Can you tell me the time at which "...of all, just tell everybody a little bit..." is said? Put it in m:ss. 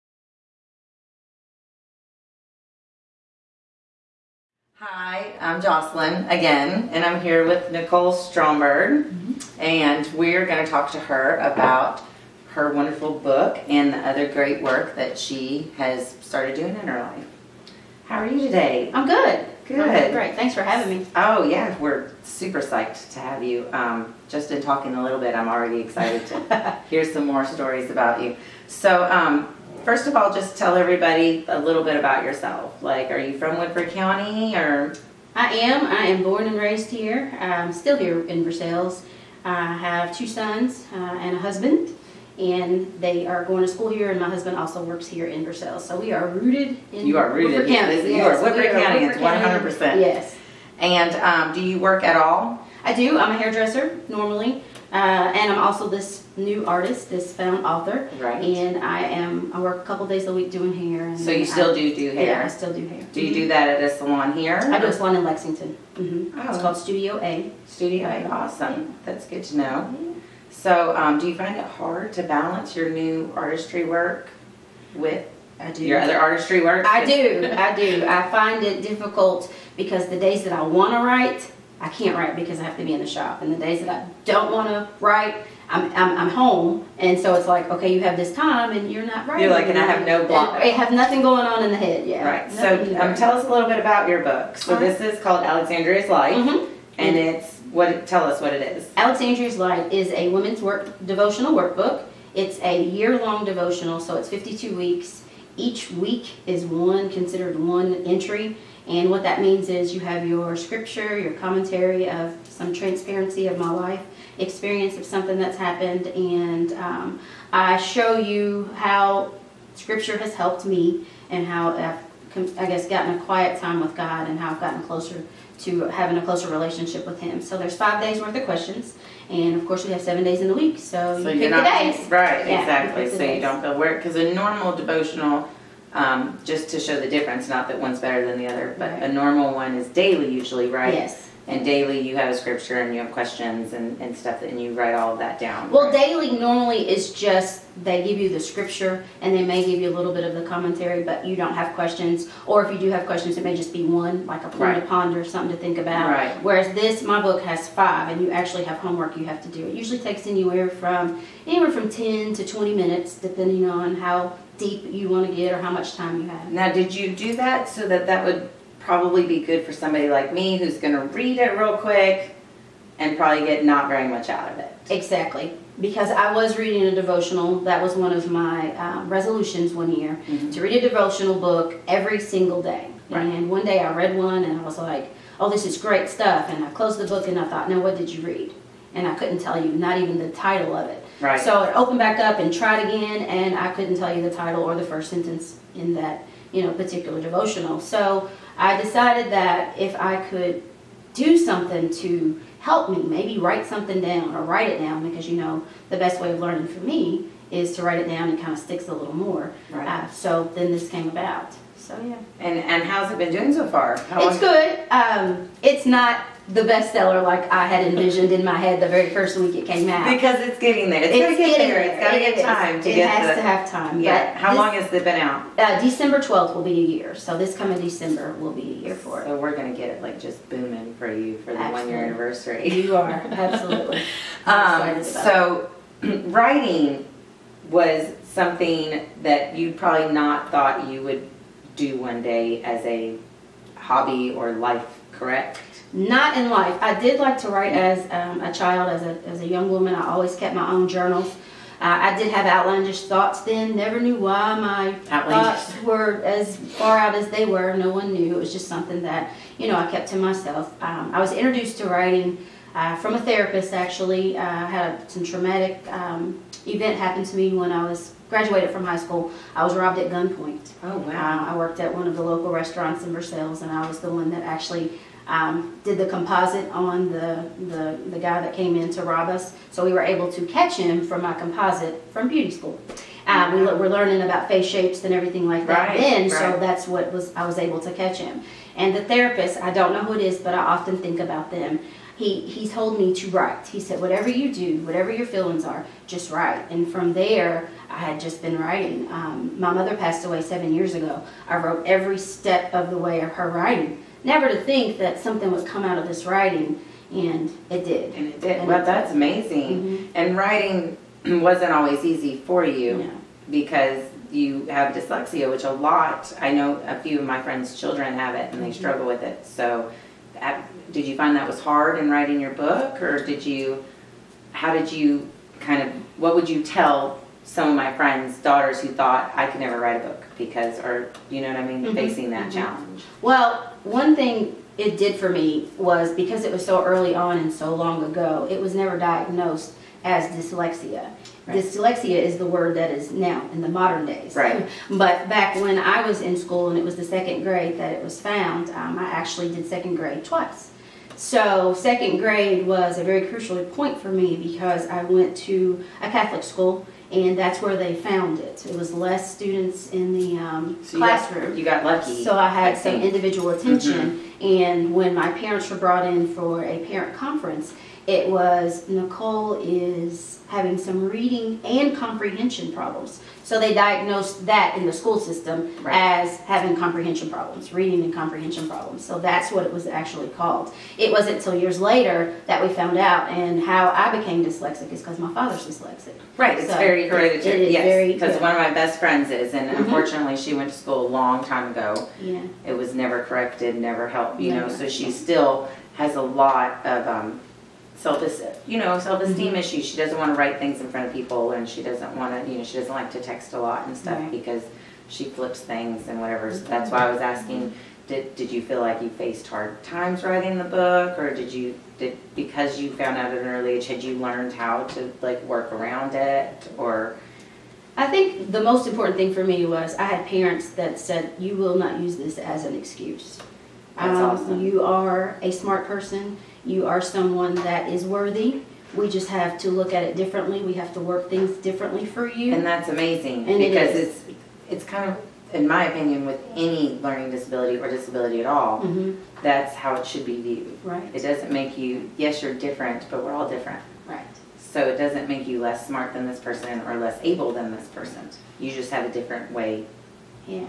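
0:30.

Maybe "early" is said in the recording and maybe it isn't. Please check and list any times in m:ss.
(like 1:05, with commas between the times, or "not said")
5:36, 6:53.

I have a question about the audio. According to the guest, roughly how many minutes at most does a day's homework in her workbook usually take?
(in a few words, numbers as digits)
20 minutes.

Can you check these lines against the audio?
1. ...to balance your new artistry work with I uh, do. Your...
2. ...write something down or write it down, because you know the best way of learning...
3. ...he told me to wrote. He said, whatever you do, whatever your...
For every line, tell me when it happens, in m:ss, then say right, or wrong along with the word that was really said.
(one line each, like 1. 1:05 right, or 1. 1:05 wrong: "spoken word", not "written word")
1. 1:12 right
2. 3:23 right
3. 4:52 wrong: "write", not "wrote".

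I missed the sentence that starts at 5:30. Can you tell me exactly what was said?
because, or you know what I mean, mm-hmm.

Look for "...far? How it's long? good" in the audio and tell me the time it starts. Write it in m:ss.
3:33.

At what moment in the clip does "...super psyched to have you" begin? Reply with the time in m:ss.
0:22.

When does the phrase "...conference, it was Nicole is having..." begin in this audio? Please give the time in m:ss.
6:07.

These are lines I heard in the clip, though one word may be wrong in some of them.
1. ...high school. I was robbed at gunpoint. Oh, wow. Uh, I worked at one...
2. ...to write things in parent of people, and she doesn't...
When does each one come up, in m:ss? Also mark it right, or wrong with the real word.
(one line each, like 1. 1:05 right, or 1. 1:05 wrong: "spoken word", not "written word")
1. 4:28 right
2. 6:40 wrong: "front", not "parent".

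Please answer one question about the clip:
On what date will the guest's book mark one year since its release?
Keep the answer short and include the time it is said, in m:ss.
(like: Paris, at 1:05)
December 12, at 3:45.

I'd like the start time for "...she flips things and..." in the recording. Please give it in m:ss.
6:45.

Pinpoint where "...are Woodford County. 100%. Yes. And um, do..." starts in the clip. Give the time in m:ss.
0:48.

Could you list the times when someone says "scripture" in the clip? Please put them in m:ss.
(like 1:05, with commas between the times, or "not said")
1:50, 1:59, 2:22, 2:28.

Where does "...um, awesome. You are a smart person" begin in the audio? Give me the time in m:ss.
7:04.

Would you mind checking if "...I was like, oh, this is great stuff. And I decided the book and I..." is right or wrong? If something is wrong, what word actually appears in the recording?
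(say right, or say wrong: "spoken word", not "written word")
wrong: "closed", not "decided".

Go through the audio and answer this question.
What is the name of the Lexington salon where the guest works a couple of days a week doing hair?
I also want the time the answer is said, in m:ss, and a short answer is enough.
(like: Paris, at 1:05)
Studio A, at 1:06.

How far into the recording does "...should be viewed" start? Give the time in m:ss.
7:20.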